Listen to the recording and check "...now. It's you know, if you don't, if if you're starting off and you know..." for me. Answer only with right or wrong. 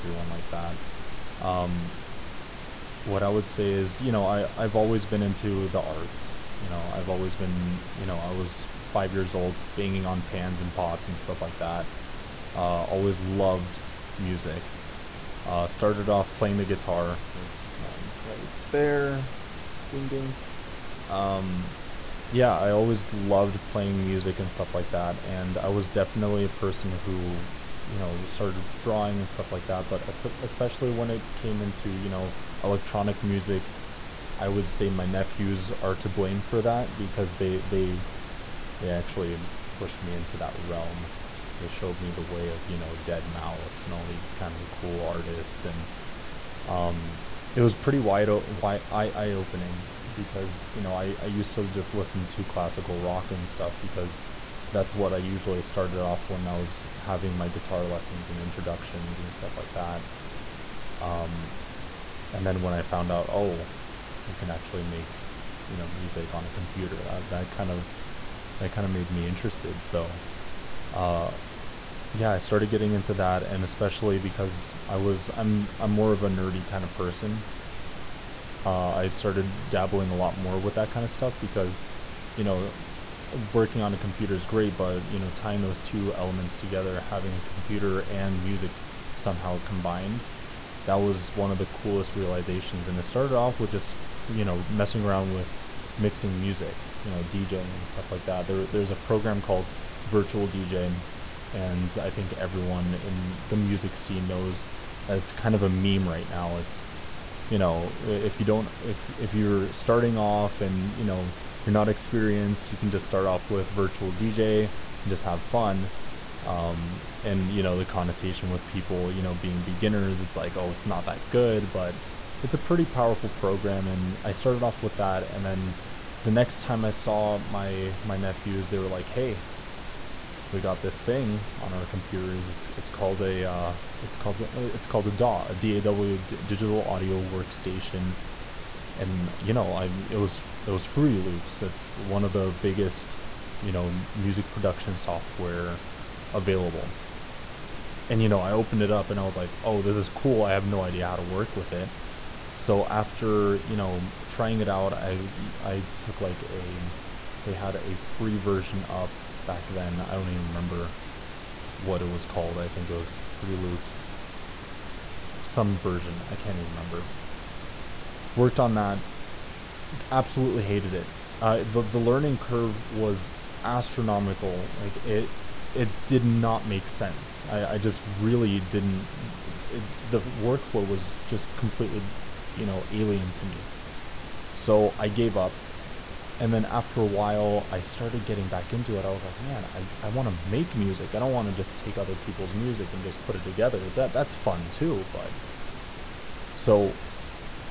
right.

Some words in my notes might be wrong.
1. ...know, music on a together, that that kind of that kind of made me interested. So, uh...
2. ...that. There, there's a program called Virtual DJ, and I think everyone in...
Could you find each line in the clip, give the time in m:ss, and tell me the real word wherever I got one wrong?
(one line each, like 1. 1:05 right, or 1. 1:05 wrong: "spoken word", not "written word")
1. 1:05 wrong: "computer", not "together"
2. 1:38 right.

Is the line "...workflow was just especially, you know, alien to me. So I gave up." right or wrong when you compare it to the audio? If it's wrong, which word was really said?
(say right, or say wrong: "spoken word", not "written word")
wrong: "completely", not "especially".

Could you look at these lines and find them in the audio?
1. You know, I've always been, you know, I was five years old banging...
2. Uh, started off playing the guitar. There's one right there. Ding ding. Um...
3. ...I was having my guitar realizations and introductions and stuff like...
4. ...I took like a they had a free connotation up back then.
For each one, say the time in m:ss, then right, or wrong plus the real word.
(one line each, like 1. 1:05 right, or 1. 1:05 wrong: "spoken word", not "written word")
1. 0:06 right
2. 0:15 right
3. 0:56 wrong: "lessons", not "realizations"
4. 2:35 wrong: "version", not "connotation".